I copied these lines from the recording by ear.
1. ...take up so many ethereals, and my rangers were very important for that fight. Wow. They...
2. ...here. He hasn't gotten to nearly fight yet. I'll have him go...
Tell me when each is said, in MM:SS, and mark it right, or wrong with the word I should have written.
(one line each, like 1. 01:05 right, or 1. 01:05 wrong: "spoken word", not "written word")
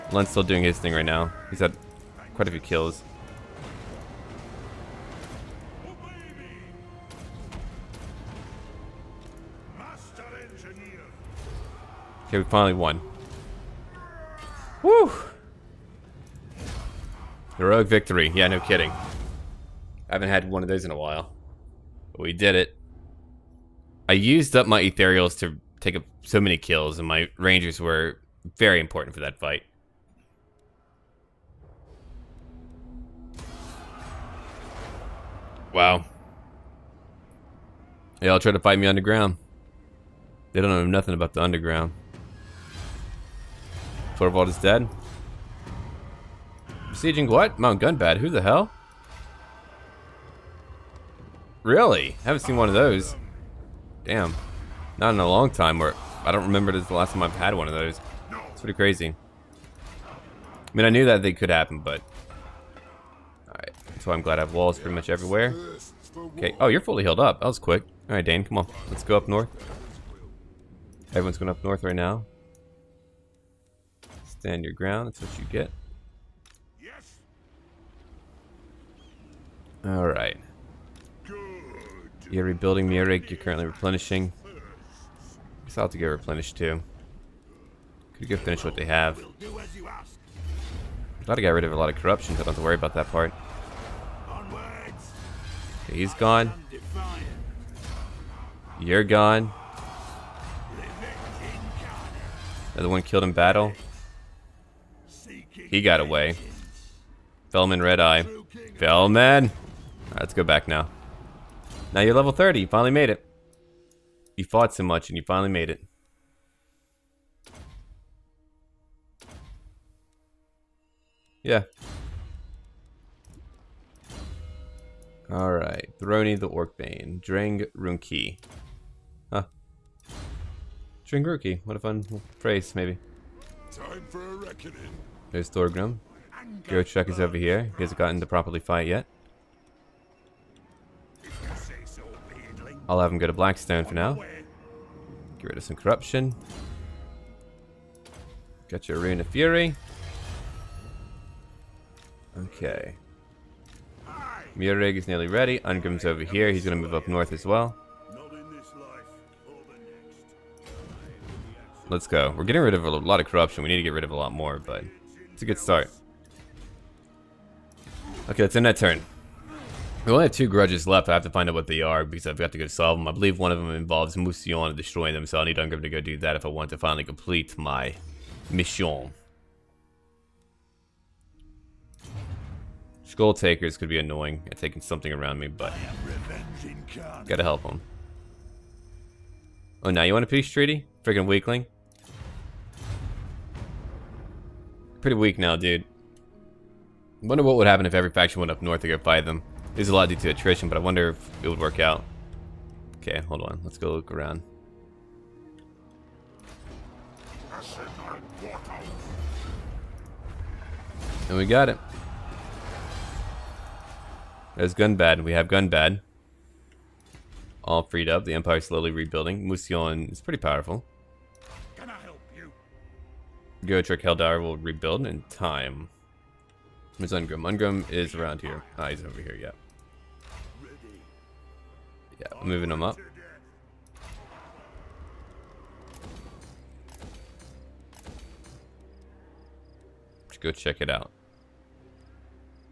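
1. 00:25 wrong: "kills", not "ethereals"
2. 02:17 wrong: "properly", not "nearly".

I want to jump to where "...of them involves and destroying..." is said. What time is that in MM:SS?
02:53.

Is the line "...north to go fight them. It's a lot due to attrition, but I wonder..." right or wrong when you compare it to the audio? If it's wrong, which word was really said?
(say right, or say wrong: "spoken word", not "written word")
right.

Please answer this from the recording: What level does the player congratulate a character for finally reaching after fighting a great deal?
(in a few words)
30.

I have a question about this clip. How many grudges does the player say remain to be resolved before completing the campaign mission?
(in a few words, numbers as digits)
2.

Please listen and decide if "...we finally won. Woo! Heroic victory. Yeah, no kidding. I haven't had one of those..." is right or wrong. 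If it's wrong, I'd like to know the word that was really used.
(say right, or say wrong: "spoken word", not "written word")
right.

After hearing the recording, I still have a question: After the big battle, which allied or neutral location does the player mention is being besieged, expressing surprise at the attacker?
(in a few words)
Mount Gunbad.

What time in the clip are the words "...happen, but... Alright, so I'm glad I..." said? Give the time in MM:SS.
01:01.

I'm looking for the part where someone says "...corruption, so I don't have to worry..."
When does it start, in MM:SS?
01:31.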